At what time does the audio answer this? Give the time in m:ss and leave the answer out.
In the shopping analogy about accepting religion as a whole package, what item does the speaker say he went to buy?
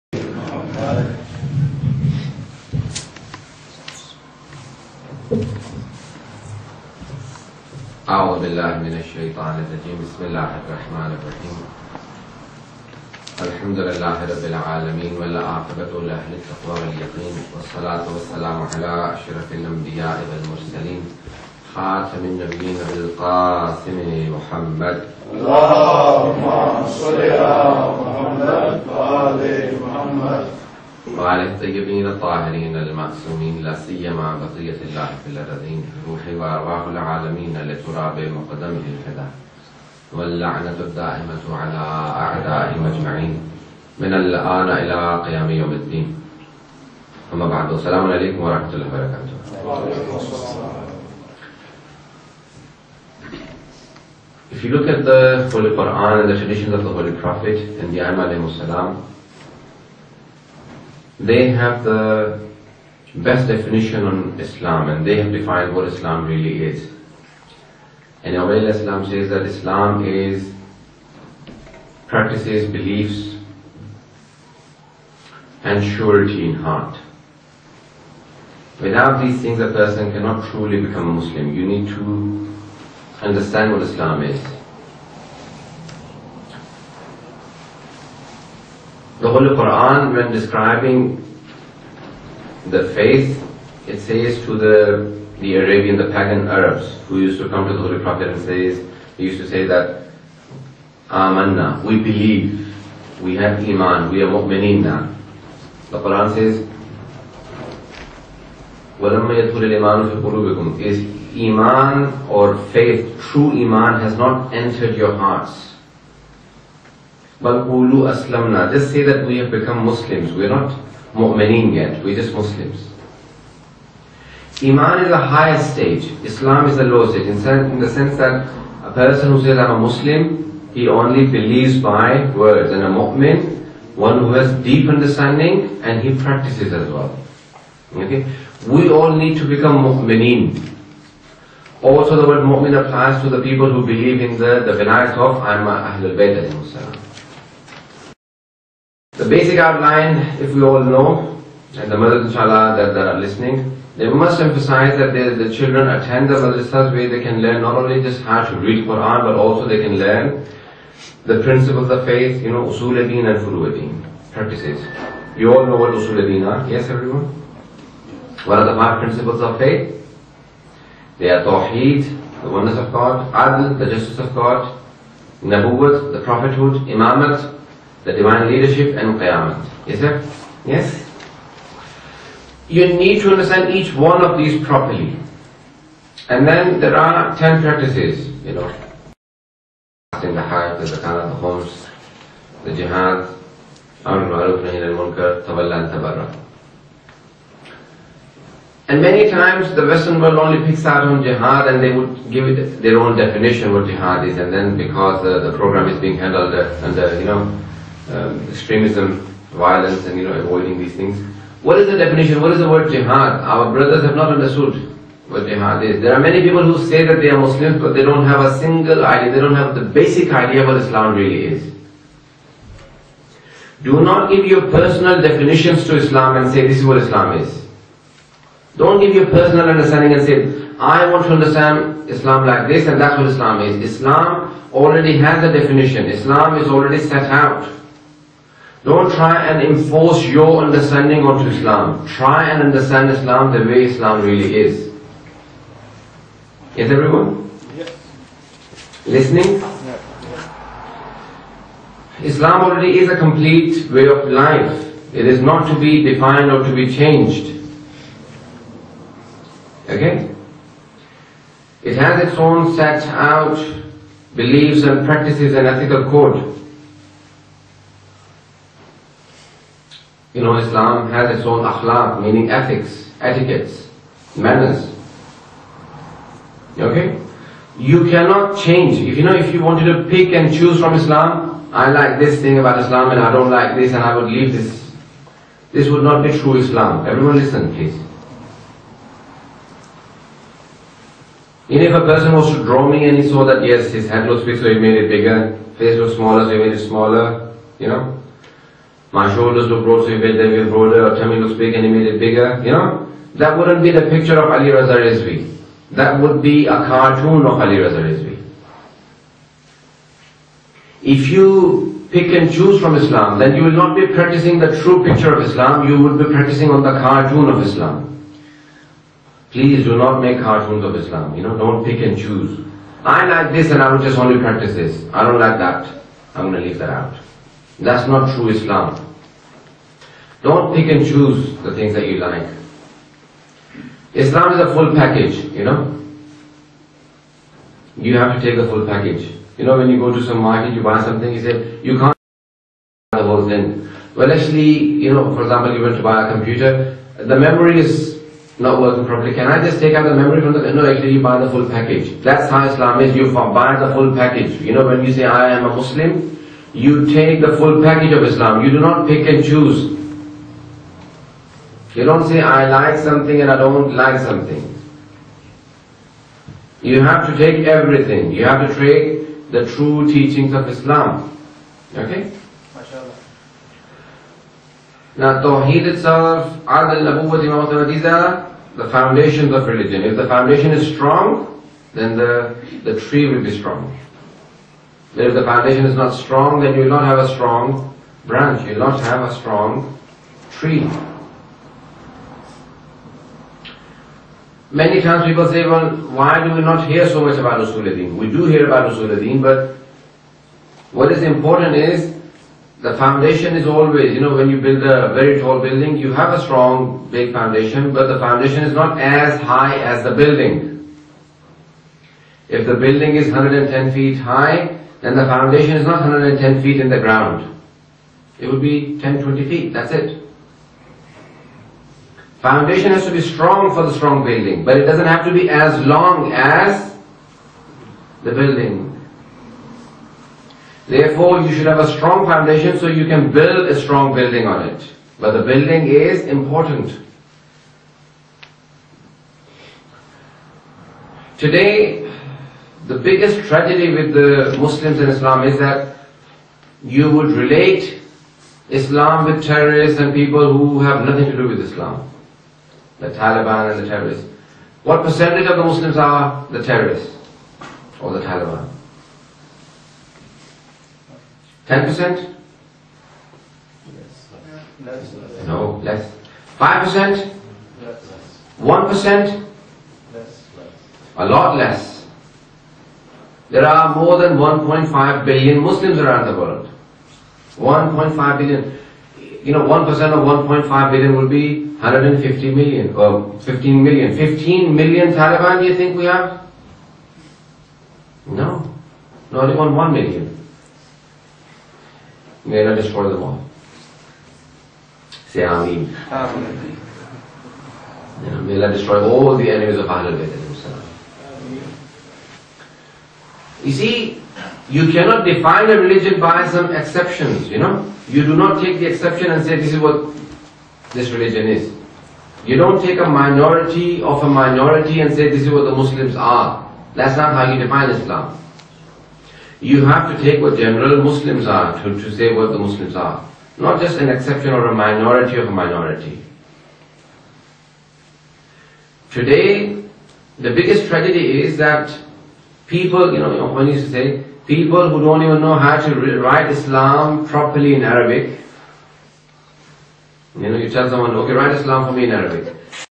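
5:46.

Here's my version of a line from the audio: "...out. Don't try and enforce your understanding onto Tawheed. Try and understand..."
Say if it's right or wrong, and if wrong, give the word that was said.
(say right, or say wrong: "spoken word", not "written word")
wrong: "Islam", not "Tawheed".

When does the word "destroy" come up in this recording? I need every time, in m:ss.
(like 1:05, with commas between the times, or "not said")
8:12, 8:18.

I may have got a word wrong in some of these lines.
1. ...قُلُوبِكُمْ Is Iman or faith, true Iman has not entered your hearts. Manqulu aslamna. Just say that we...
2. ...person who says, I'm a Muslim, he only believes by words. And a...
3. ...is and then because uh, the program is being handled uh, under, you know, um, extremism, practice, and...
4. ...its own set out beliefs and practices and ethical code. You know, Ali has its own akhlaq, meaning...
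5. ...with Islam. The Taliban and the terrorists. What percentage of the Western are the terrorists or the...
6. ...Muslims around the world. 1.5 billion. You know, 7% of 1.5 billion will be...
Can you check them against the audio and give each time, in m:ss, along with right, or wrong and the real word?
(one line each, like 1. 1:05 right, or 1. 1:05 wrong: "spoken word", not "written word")
1. 1:50 right
2. 2:08 right
3. 3:24 wrong: "violence", not "practice"
4. 4:22 wrong: "Islam", not "Ali"
5. 7:31 wrong: "Muslims", not "Western"
6. 7:55 wrong: "1", not "7".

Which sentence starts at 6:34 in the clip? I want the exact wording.
Many times people say, well, why do we not hear so much about Usuluddin?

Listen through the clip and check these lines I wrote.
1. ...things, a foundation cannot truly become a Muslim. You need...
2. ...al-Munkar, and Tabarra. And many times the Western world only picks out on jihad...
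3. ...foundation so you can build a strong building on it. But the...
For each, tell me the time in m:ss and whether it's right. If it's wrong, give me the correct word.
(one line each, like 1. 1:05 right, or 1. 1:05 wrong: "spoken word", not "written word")
1. 1:19 wrong: "person", not "foundation"
2. 3:14 right
3. 7:12 right.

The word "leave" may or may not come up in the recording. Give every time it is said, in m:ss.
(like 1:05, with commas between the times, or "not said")
4:44, 5:26.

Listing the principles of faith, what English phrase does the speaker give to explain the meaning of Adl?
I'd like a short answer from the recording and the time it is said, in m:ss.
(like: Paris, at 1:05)
the justice of God, at 2:53.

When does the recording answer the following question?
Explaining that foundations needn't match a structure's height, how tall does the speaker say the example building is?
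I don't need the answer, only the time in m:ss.
6:53.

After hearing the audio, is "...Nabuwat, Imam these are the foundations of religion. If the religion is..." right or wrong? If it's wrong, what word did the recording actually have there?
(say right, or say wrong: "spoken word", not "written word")
wrong: "foundation", not "religion".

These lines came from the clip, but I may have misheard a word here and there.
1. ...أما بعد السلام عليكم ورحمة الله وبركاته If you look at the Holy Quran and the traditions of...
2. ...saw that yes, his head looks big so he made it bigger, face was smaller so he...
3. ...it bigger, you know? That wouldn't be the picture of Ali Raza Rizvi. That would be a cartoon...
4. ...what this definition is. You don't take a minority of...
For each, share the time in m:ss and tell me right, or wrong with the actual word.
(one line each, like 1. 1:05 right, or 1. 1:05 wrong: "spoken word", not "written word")
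1. 0:47 right
2. 4:53 right
3. 5:02 right
4. 8:29 wrong: "religion", not "definition".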